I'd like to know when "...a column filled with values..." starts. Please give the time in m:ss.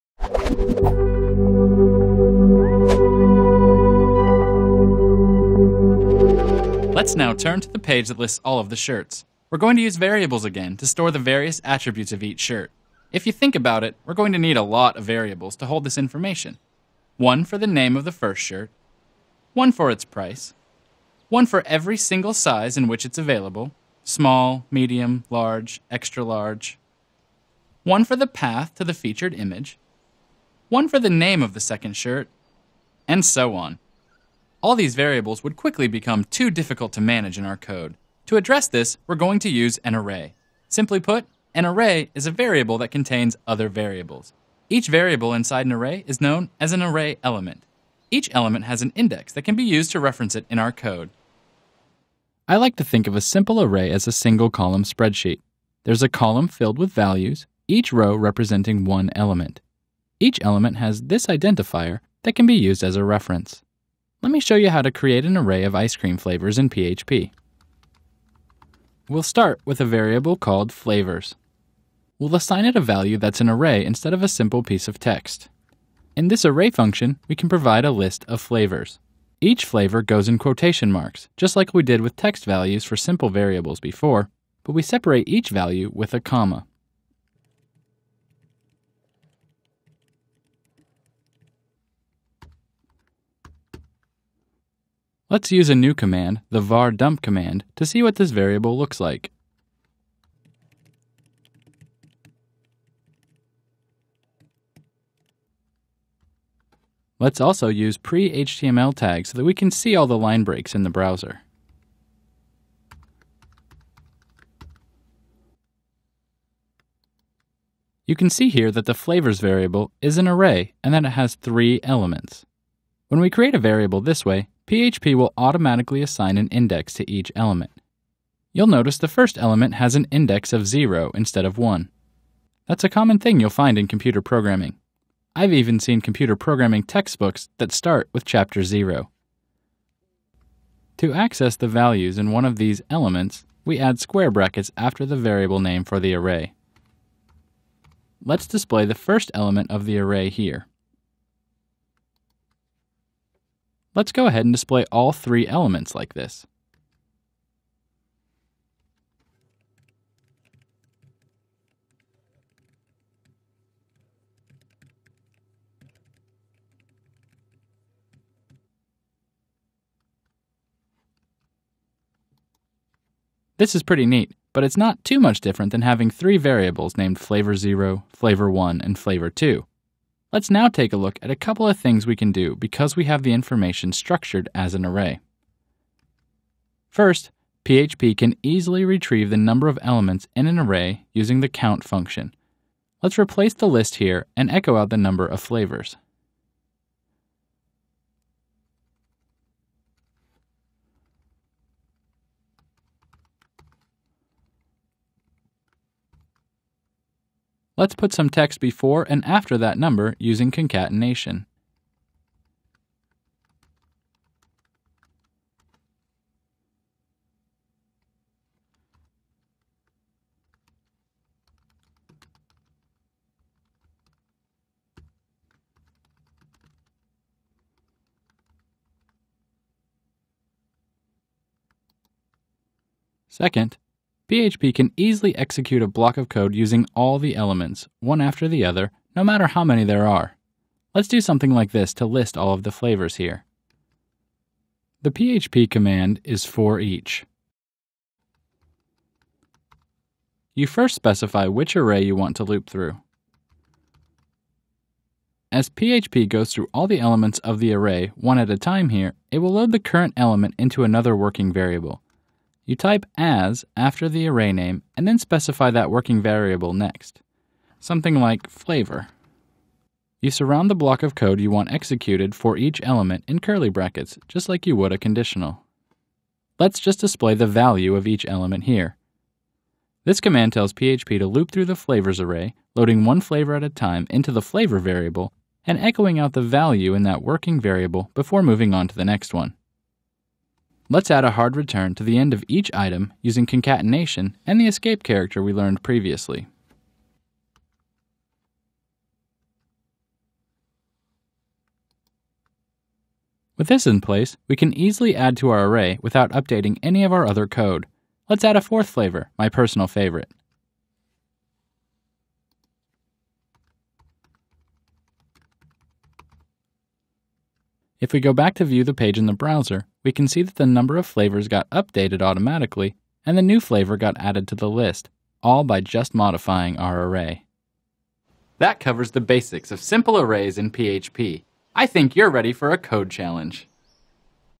0:56.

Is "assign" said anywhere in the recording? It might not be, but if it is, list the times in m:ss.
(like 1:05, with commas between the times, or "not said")
1:12, 2:06.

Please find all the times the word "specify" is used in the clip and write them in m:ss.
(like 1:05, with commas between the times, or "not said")
4:10, 4:25.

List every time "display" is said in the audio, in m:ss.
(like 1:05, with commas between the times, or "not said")
2:28, 2:34, 4:37.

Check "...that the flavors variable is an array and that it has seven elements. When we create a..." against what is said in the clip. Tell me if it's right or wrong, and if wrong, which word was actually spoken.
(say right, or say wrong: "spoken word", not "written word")
wrong: "three", not "seven".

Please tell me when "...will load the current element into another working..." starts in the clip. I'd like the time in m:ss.
4:19.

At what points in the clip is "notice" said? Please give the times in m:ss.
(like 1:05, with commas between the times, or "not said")
2:08.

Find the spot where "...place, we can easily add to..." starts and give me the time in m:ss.
5:04.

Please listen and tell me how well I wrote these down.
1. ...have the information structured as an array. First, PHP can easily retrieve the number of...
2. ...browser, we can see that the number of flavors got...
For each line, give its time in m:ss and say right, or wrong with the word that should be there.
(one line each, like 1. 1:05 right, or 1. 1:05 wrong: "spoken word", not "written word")
1. 3:03 right
2. 5:19 right.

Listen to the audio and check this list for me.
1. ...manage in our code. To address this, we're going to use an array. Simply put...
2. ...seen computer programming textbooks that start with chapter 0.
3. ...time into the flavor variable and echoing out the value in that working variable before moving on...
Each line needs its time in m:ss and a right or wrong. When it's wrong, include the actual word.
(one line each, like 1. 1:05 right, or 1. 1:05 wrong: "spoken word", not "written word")
1. 0:37 right
2. 2:15 right
3. 4:43 right.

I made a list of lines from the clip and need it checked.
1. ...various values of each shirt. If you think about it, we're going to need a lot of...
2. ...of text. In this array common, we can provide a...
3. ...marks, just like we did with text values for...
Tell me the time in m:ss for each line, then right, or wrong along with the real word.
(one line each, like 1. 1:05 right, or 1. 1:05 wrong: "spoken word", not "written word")
1. 0:11 wrong: "attributes", not "values"
2. 1:14 wrong: "function", not "common"
3. 1:20 right.